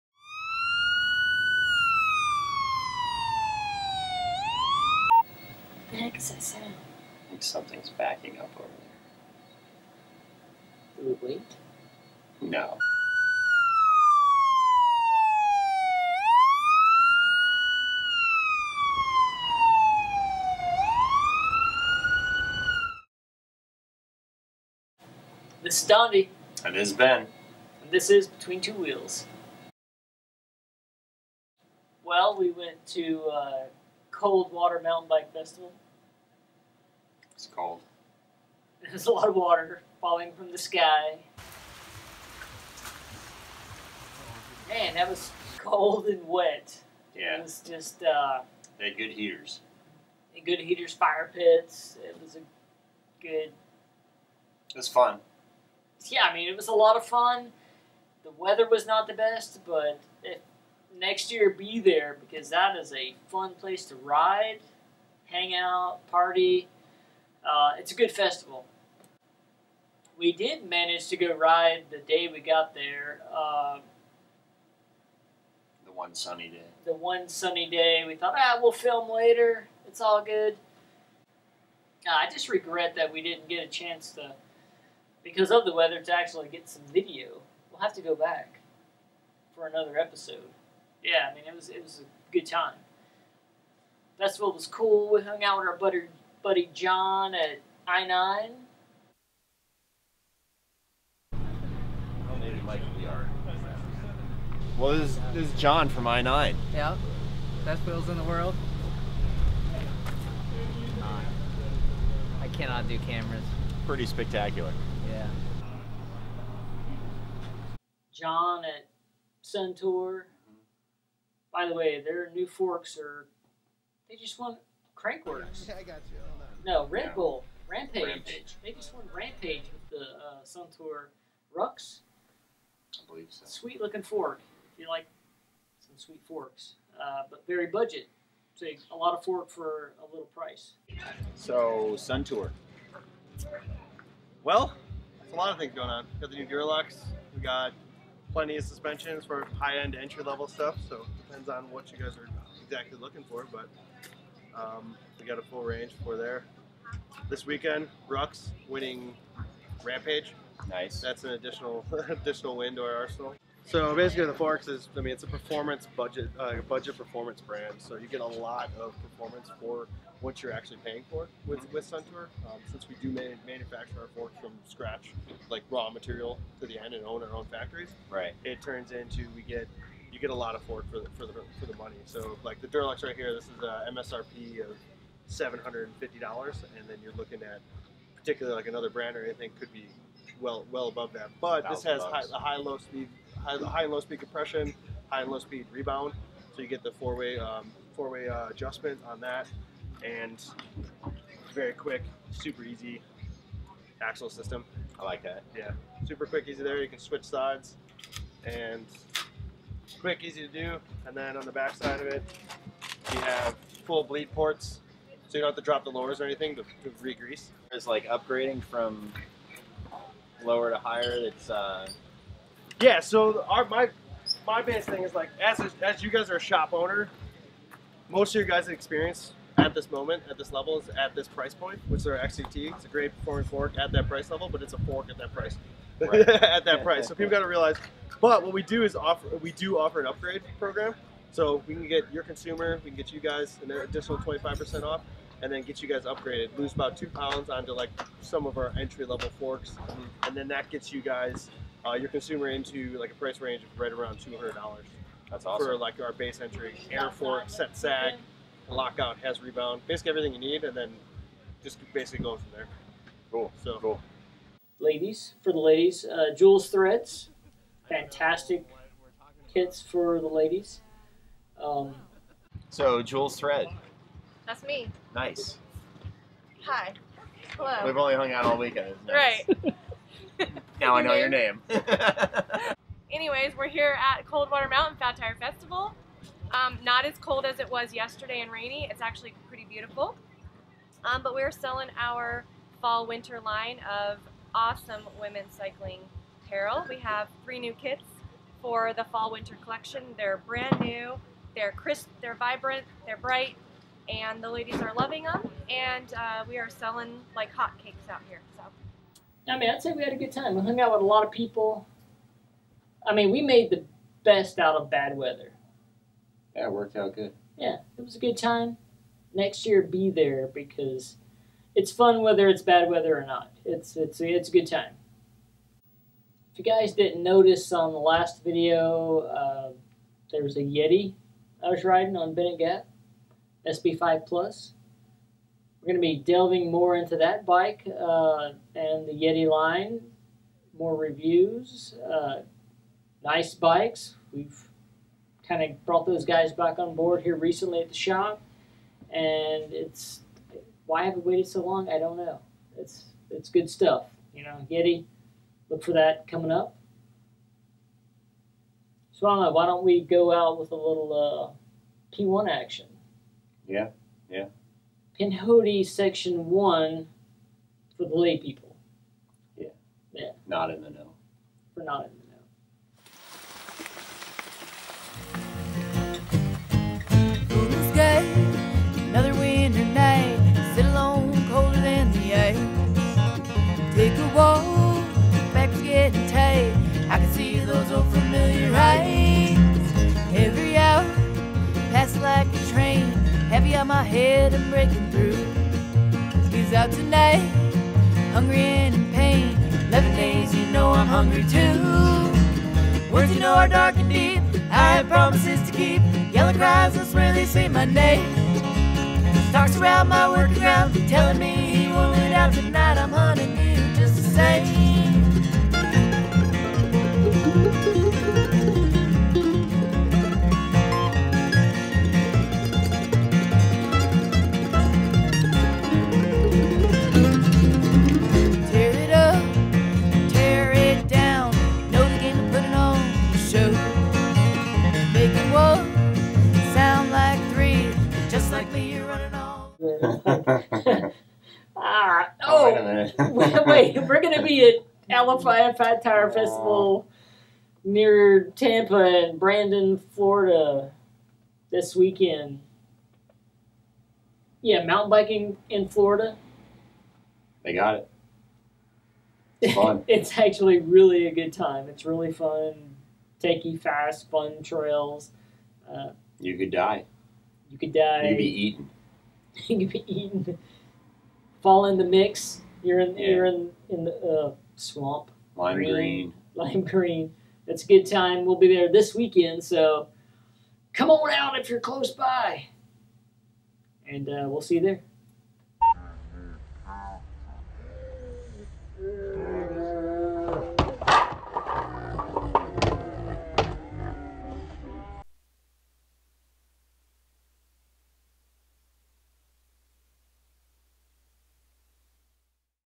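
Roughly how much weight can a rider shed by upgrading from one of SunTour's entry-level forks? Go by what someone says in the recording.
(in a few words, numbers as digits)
two pounds.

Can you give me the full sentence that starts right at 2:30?
So depends on what you guys are exactly looking for, but um, we got a full range for there.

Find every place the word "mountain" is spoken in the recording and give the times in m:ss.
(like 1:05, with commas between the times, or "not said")
0:34, 4:44, 7:34.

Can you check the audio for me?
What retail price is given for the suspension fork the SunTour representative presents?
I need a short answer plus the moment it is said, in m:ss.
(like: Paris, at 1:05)
$750, at 3:05.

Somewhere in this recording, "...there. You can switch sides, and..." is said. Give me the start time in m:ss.
3:26.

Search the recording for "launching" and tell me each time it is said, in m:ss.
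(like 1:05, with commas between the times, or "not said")
not said.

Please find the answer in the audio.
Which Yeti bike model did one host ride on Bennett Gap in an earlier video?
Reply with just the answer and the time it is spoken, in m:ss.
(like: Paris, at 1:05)
SB5 Plus, at 5:33.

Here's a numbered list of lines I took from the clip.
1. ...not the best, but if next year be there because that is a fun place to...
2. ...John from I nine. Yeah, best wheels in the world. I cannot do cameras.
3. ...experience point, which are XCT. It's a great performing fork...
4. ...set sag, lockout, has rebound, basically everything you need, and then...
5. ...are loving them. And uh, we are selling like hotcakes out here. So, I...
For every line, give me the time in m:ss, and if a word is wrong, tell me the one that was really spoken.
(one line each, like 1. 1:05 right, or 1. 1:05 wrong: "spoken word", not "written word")
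1. 0:58 right
2. 1:45 right
3. 3:51 wrong: "price", not "experience"
4. 4:17 right
5. 5:04 right.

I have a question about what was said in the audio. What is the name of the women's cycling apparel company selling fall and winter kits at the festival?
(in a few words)
Jules Threads.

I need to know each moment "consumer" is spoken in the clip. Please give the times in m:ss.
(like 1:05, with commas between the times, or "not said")
4:02, 4:12.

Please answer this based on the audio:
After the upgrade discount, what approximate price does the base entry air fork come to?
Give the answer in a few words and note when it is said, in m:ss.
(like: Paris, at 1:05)
$200, at 4:14.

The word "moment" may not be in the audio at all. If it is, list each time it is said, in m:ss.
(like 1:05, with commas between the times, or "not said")
3:49.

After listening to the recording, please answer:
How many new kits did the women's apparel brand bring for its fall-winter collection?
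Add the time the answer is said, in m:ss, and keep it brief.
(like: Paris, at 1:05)
three, at 4:57.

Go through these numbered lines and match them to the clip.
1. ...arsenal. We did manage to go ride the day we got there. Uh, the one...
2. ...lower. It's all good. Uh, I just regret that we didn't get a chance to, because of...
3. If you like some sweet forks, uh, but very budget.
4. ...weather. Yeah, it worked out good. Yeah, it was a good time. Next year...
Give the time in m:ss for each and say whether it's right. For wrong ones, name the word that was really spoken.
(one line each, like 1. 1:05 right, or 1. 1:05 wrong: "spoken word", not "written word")
1. 1:08 wrong: "festival", not "arsenal"
2. 1:19 wrong: "later", not "lower"
3. 2:14 right
4. 5:15 right.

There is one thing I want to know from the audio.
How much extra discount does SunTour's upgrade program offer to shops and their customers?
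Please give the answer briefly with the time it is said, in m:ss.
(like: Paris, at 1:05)
25%, at 4:04.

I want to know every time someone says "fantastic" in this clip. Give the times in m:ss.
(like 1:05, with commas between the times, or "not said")
4:27.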